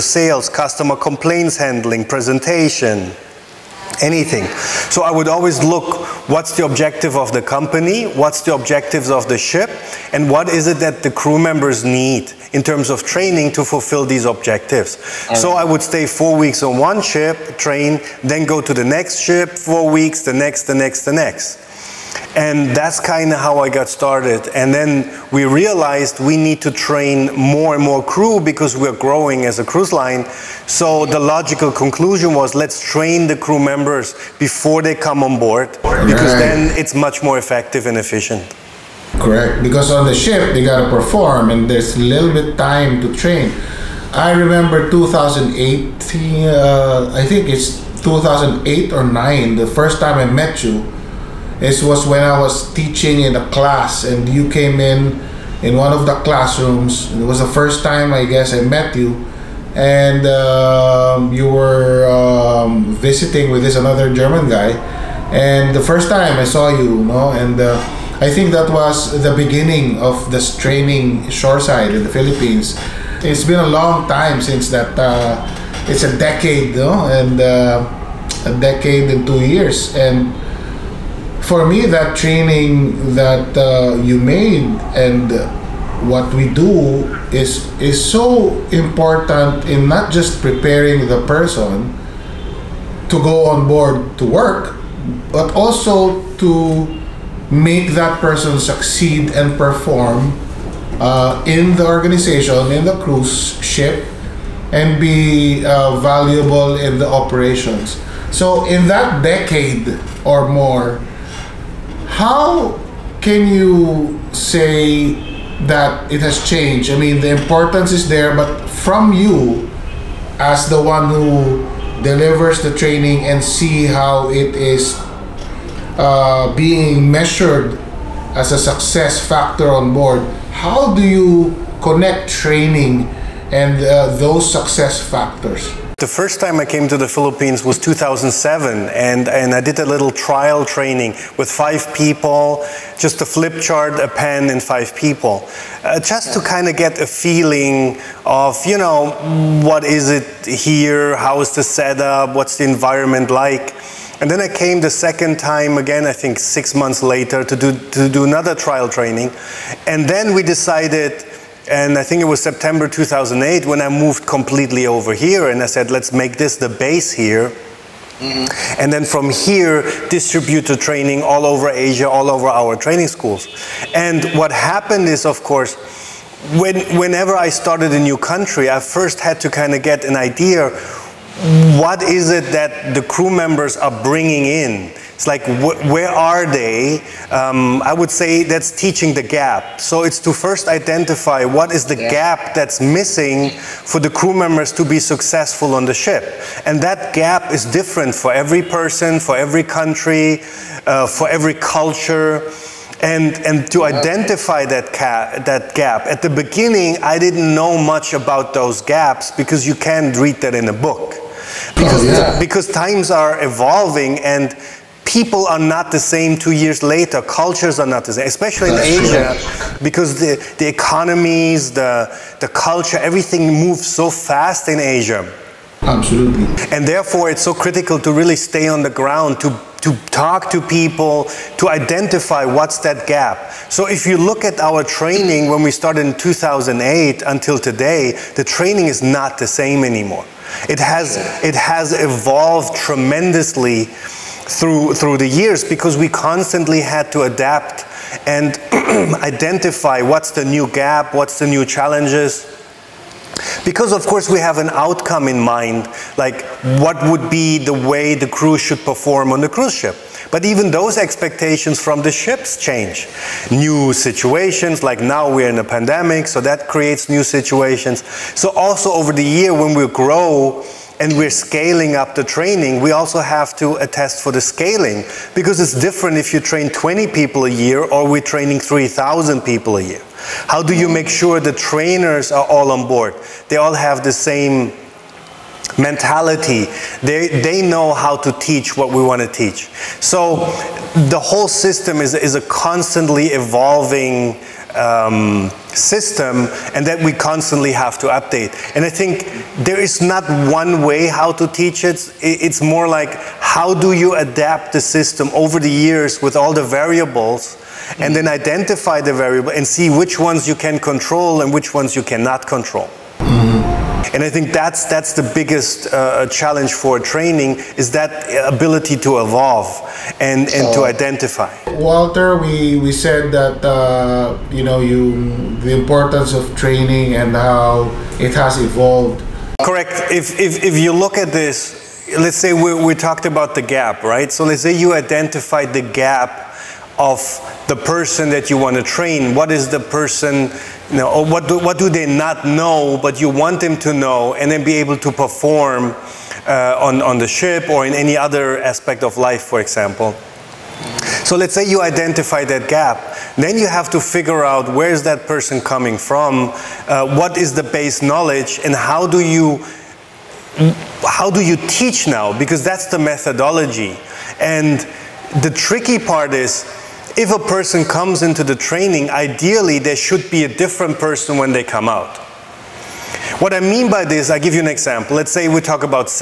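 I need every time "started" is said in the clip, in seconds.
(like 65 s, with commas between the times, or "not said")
23 s, 177 s, 235 s.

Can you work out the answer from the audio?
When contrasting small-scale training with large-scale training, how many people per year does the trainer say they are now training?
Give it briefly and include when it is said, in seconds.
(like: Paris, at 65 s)
3,000, at 278 s.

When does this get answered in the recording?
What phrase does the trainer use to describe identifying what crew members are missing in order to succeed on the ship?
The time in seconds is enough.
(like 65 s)
188 s.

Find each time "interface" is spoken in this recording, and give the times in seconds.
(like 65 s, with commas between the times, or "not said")
not said.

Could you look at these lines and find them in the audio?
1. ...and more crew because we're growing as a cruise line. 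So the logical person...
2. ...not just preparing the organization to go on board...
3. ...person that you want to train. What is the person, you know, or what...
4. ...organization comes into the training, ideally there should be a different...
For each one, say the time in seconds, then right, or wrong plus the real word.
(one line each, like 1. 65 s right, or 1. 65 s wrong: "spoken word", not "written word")
1. 27 s wrong: "conclusion", not "person"
2. 89 s wrong: "person", not "organization"
3. 337 s right
4. 367 s wrong: "person", not "organization".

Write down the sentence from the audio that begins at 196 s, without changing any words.
And that gap is different for every person, for every country, uh, for every culture.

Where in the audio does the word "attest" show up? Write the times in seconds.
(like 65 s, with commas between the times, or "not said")
273 s.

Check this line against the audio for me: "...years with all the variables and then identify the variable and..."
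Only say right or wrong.
right.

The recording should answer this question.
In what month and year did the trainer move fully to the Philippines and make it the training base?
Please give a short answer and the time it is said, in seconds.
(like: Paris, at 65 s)
September 2008, at 162 s.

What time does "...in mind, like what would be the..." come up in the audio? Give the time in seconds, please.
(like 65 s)
255 s.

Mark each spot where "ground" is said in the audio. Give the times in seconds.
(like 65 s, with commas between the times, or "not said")
228 s.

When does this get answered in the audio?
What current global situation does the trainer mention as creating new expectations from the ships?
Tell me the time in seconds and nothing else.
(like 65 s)
265 s.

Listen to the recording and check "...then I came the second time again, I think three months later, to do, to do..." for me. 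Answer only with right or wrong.
wrong.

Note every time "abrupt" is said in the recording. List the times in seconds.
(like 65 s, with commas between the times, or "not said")
not said.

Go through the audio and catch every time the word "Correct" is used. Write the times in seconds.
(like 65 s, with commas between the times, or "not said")
39 s, 329 s.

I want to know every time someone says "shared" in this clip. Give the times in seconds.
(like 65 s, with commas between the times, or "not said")
not said.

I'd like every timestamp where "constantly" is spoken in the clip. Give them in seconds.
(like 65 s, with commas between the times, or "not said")
246 s, 292 s, 297 s.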